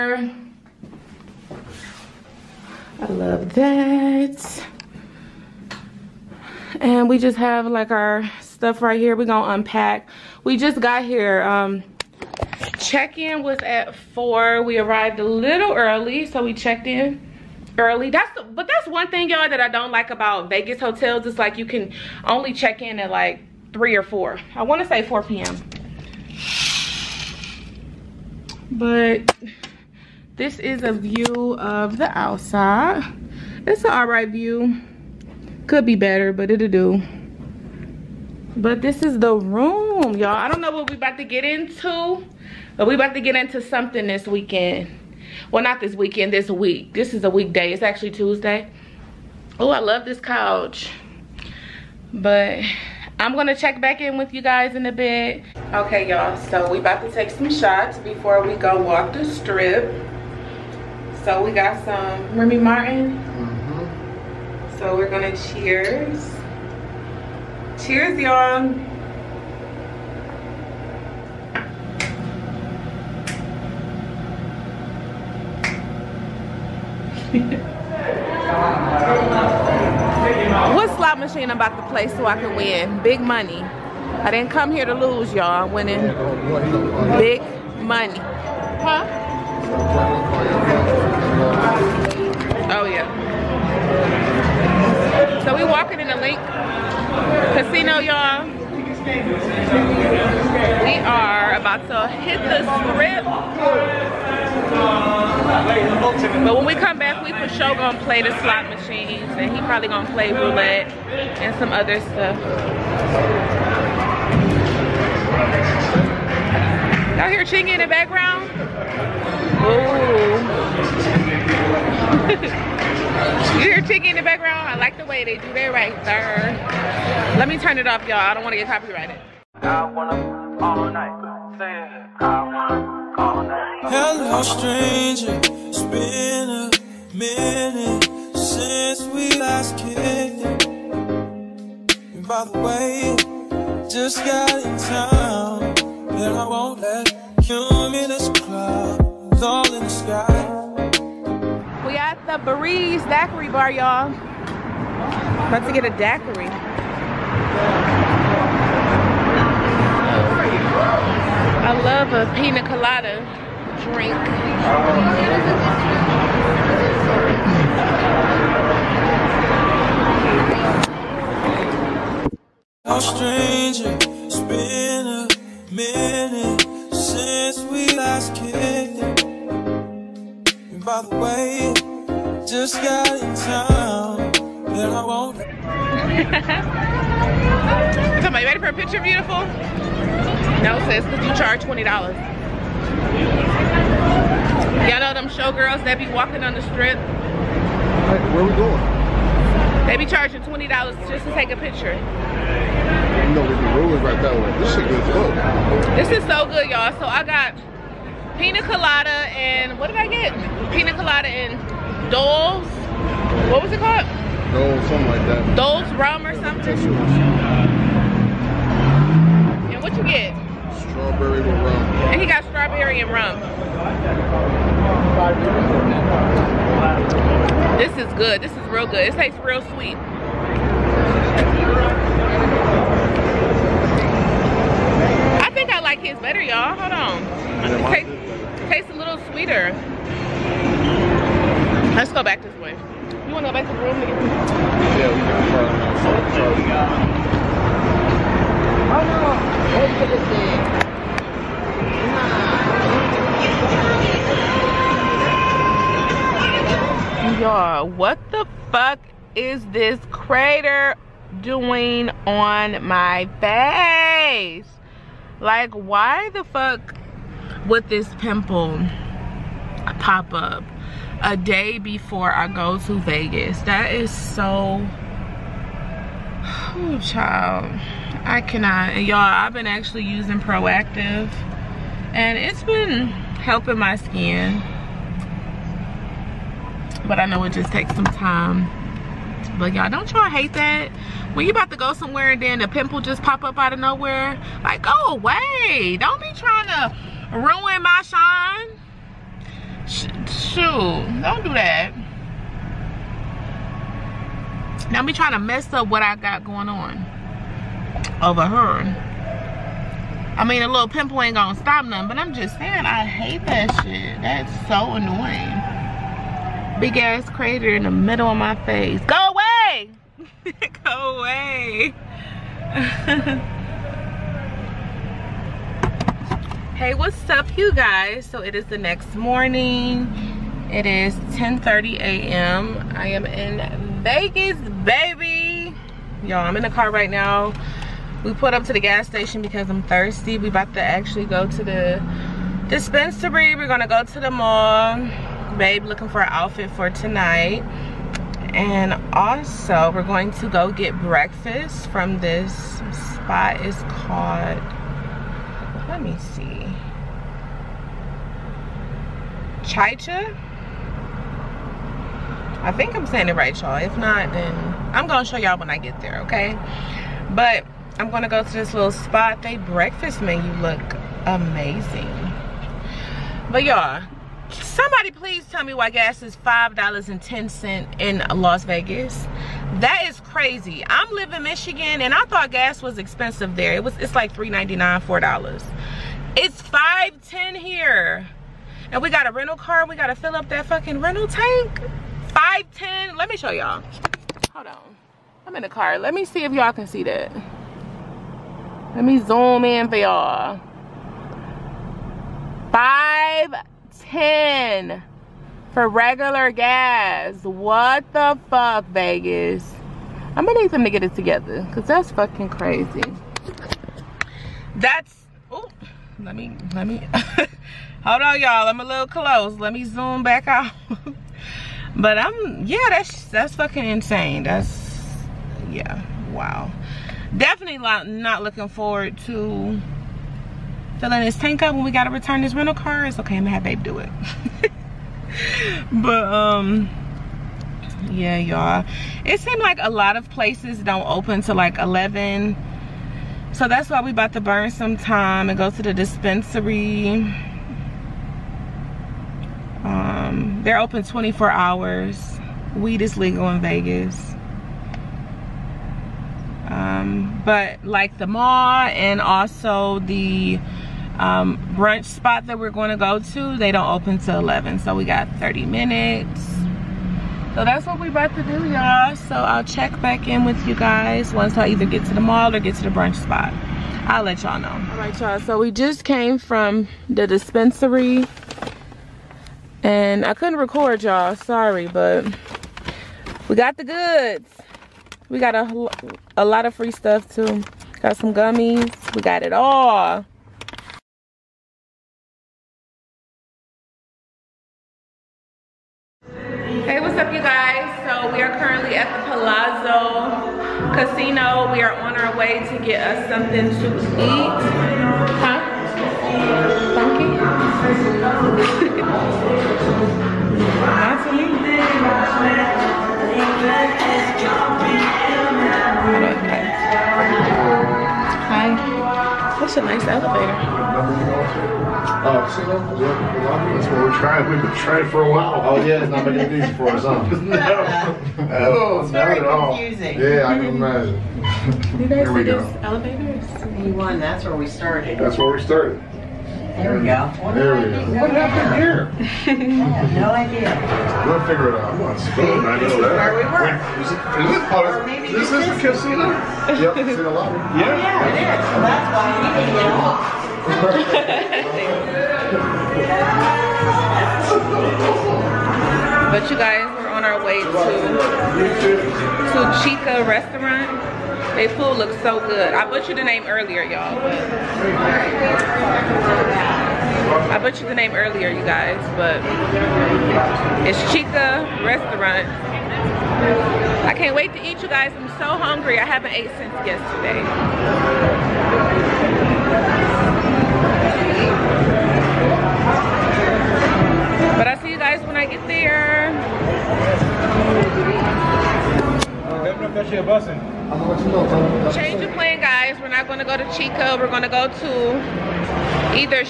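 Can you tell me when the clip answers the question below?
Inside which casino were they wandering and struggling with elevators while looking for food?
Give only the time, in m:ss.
8:19.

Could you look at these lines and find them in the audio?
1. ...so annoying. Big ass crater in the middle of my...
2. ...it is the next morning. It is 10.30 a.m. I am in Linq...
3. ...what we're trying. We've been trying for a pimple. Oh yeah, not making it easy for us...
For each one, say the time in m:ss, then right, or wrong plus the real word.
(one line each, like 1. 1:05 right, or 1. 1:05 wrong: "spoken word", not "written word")
1. 5:14 right
2. 5:28 wrong: "Vegas", not "Linq"
3. 8:43 wrong: "while", not "pimple".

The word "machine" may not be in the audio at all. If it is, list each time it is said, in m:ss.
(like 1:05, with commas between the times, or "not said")
1:21, 1:48.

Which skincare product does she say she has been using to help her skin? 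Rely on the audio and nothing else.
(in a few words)
Proactiv.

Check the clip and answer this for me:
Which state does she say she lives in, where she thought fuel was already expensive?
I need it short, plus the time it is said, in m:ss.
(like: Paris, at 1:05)
Michigan, at 6:21.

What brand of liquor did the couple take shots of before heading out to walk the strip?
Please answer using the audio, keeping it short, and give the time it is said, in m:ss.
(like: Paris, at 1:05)
Remy Martin, at 1:02.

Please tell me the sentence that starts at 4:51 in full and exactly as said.
When you about to go somewhere and then the pimple just pop up out of nowhere, like go away.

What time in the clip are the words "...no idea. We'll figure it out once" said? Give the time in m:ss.
9:00.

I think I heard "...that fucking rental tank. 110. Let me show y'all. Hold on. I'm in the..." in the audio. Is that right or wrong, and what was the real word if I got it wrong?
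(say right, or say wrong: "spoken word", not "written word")
wrong: "510", not "110".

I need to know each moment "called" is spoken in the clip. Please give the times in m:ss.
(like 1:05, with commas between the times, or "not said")
3:33, 5:53.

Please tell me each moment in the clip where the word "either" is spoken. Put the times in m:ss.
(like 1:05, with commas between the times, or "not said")
7:51.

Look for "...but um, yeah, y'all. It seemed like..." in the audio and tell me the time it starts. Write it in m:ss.
7:15.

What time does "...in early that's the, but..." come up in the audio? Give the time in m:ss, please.
0:16.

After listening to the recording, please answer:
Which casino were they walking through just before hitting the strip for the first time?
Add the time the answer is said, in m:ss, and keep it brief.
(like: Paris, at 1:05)
Linq, at 1:36.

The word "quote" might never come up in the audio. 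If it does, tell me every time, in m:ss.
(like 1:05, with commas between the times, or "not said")
not said.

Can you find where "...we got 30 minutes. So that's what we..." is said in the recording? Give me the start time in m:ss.
7:44.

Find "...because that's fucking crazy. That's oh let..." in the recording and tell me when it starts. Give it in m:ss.
6:51.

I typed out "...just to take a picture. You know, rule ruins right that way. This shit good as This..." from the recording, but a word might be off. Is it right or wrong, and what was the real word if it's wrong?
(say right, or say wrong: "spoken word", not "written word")
right.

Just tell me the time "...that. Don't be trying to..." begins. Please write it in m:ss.
5:01.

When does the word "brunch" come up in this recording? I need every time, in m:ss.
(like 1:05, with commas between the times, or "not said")
7:41, 7:52.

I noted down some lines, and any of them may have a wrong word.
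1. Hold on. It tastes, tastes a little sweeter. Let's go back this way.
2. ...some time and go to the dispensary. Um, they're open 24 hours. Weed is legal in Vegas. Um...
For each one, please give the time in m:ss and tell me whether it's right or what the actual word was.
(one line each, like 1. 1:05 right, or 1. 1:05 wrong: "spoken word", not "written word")
1. 3:56 right
2. 7:24 right.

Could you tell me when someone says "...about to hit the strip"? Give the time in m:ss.
1:41.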